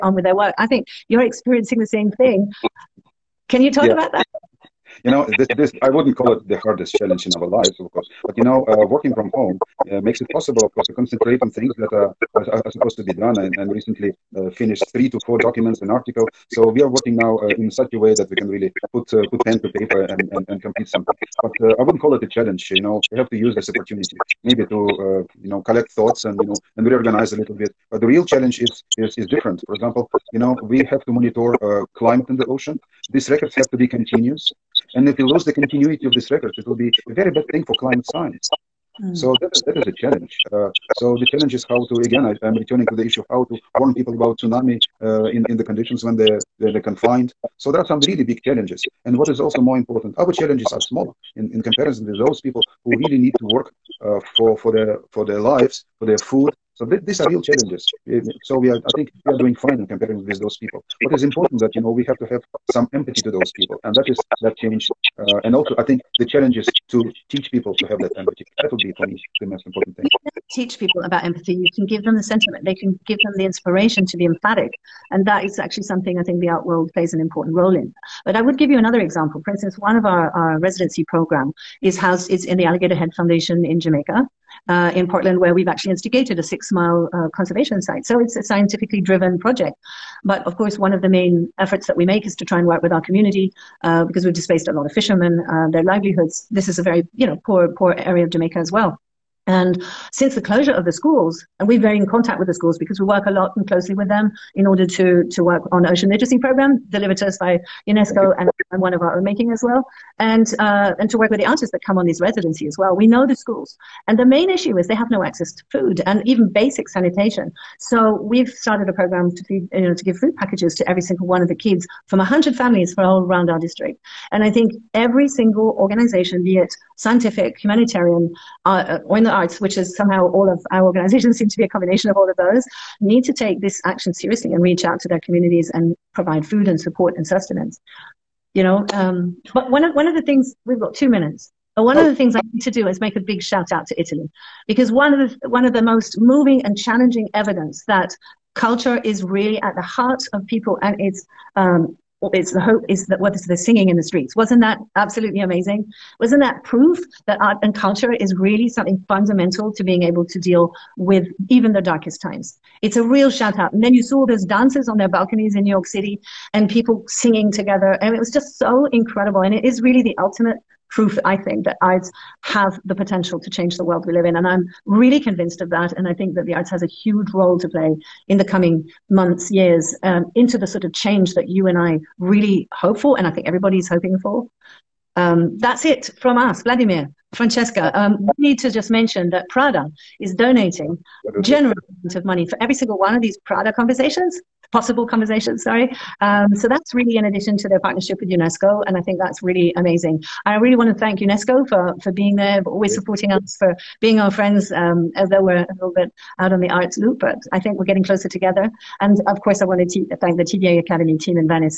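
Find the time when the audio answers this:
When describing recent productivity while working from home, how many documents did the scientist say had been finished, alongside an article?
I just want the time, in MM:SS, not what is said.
00:14.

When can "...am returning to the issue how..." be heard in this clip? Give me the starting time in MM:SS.
00:42.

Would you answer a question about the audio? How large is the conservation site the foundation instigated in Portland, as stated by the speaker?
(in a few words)
6 miles.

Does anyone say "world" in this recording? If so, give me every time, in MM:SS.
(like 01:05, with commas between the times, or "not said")
01:16, 02:53.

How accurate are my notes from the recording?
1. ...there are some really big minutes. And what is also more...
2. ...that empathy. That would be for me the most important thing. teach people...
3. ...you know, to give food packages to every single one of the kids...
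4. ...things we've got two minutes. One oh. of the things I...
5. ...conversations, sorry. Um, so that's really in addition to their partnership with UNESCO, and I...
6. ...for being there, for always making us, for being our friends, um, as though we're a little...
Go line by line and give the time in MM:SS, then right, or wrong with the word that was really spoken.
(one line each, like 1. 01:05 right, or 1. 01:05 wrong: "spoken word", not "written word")
1. 00:47 wrong: "challenges", not "minutes"
2. 01:08 right
3. 01:59 right
4. 02:20 right
5. 03:15 right
6. 03:22 wrong: "supporting", not "making".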